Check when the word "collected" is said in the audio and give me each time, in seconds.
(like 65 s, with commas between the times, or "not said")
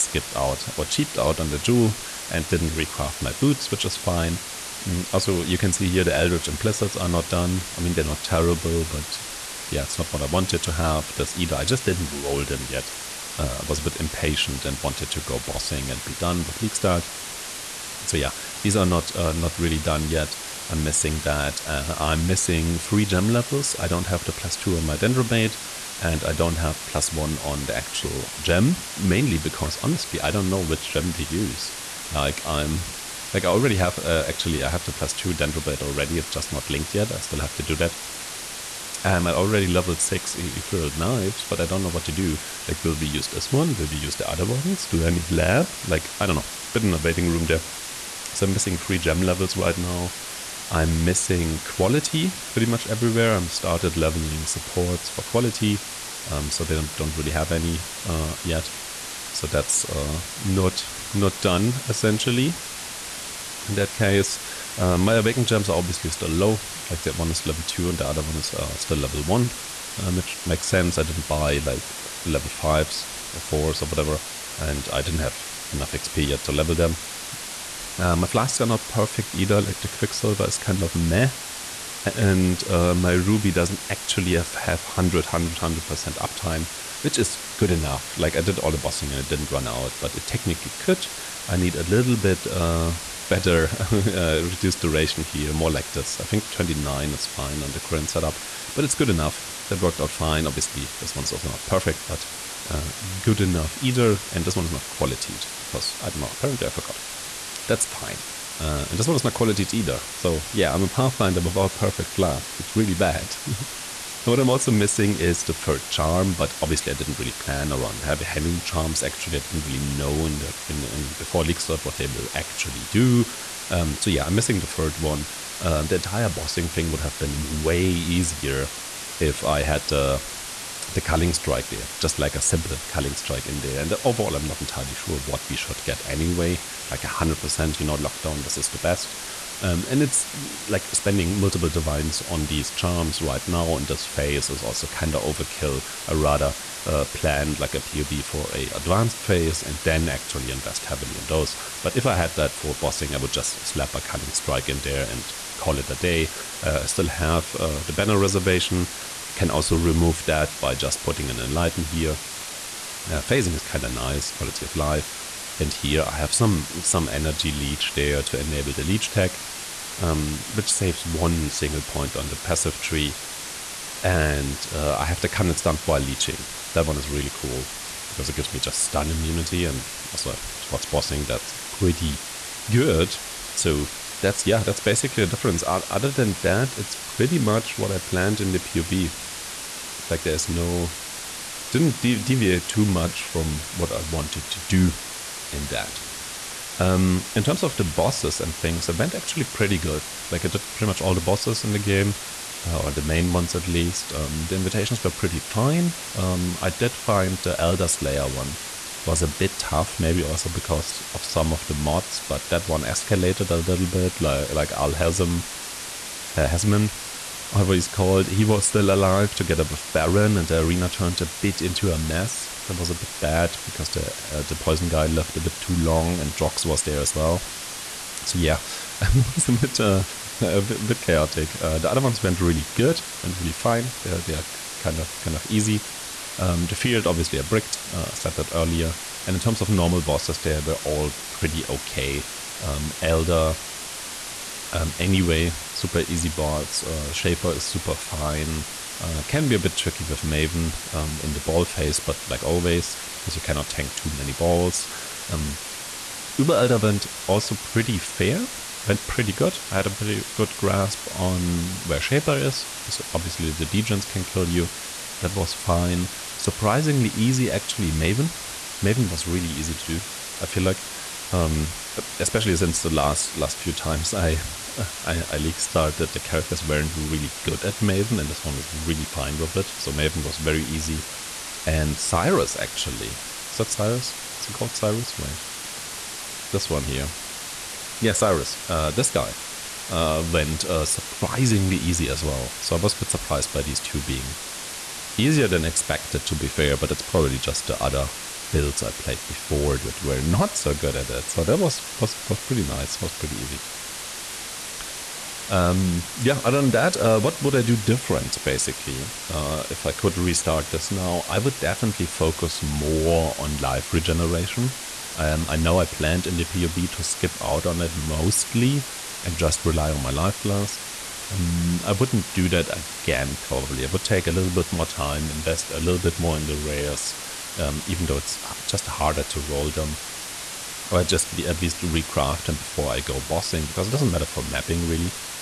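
not said.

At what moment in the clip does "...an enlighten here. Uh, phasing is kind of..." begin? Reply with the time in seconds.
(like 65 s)
161 s.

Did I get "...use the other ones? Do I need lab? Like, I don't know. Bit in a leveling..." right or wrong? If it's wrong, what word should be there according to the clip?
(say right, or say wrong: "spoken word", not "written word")
wrong: "waiting", not "leveling".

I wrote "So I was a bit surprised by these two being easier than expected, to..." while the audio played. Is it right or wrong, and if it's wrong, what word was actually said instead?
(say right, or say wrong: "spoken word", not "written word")
right.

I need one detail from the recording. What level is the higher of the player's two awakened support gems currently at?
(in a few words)
2.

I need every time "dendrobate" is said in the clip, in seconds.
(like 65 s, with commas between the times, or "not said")
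24 s, 35 s.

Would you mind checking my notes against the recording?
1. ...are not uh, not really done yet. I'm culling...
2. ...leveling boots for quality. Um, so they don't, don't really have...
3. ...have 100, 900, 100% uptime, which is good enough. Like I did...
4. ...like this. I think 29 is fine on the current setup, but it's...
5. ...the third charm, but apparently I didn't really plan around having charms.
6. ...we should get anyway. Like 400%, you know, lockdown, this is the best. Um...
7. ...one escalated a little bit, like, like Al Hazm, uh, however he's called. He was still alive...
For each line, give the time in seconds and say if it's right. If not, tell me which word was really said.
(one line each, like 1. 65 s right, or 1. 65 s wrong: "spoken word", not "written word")
1. 18 s wrong: "missing", not "culling"
2. 53 s wrong: "supports", not "boots"
3. 84 s wrong: "100", not "900"
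4. 95 s right
5. 115 s wrong: "obviously", not "apparently"
6. 135 s wrong: "100", not "400"
7. 212 s right.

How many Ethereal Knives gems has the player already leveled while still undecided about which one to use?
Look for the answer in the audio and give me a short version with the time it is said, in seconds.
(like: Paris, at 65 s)
6, at 40 s.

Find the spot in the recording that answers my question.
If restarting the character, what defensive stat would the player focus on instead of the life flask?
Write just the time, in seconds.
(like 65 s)
313 s.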